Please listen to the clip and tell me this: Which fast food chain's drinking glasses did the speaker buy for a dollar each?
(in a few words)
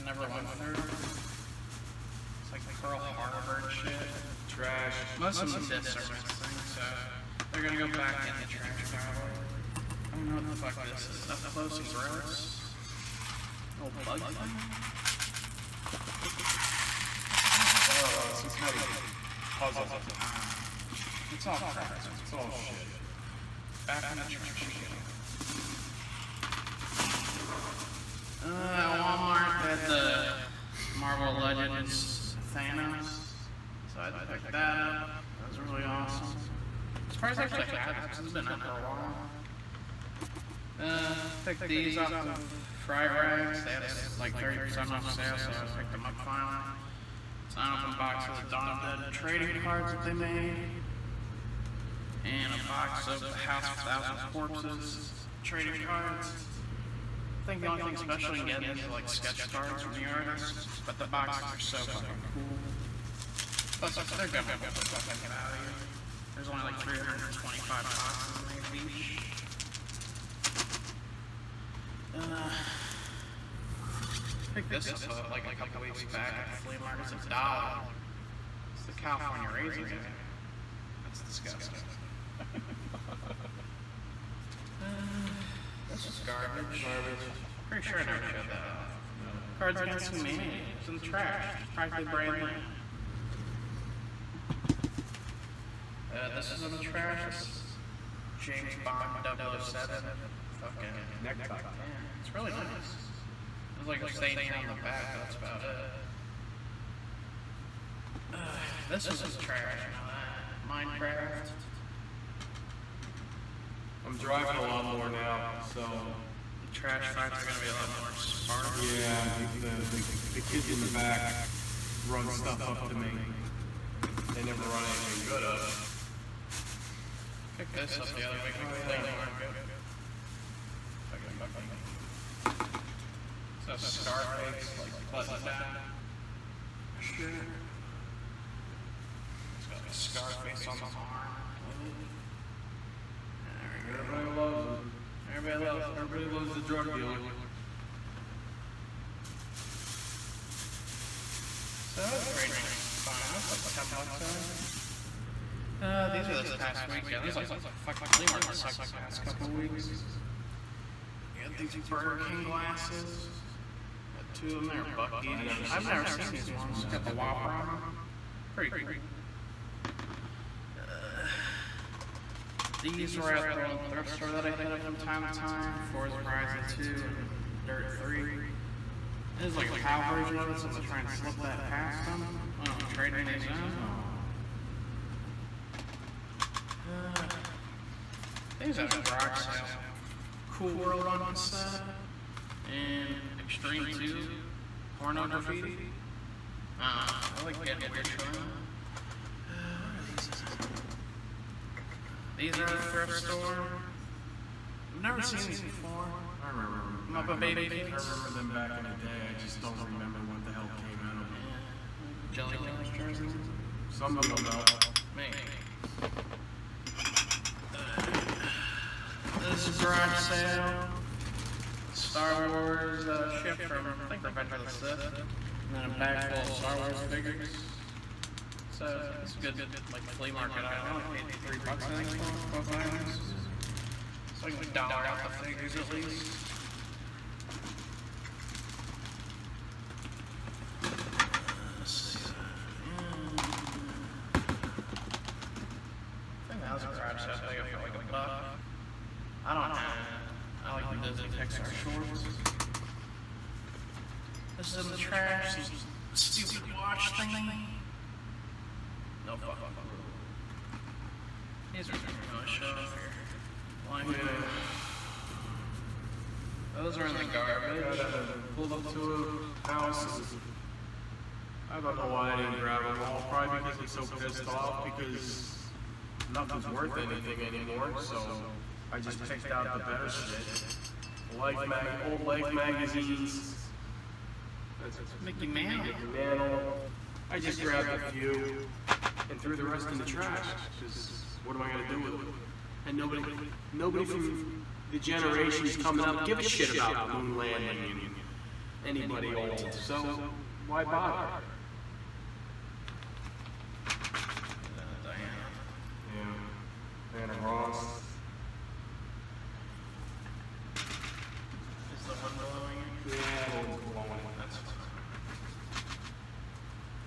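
Burger King.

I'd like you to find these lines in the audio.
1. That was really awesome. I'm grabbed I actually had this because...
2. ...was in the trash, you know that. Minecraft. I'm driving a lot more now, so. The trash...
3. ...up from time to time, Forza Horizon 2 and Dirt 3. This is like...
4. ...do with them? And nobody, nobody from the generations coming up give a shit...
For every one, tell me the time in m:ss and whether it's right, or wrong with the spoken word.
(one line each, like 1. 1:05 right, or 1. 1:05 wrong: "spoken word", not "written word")
1. 0:35 wrong: "surprised", not "grabbed"
2. 1:49 right
3. 2:54 right
4. 4:51 right.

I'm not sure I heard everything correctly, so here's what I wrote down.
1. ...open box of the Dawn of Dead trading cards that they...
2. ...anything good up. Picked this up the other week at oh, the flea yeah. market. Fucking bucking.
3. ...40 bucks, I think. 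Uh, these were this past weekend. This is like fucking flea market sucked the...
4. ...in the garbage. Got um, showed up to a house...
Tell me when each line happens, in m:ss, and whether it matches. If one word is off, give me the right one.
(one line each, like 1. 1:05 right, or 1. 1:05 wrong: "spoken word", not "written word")
1. 0:47 right
2. 2:04 right
3. 2:33 wrong: "10", not "40"
4. 4:27 wrong: "pulled", not "showed".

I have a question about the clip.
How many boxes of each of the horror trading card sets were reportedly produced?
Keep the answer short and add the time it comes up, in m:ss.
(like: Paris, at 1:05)
325, at 1:06.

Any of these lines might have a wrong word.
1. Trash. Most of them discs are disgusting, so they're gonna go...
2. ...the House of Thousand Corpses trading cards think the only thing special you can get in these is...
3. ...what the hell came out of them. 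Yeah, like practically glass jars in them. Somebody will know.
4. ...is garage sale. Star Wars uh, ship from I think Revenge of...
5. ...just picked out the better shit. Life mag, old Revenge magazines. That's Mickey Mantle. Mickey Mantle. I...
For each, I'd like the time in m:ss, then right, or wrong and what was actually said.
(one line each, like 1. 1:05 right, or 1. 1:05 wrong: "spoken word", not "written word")
1. 0:04 wrong: "missing", not "disgusting"
2. 0:53 right
3. 3:30 wrong: "jelly", not "practically"
4. 3:39 right
5. 4:38 wrong: "Life", not "Revenge".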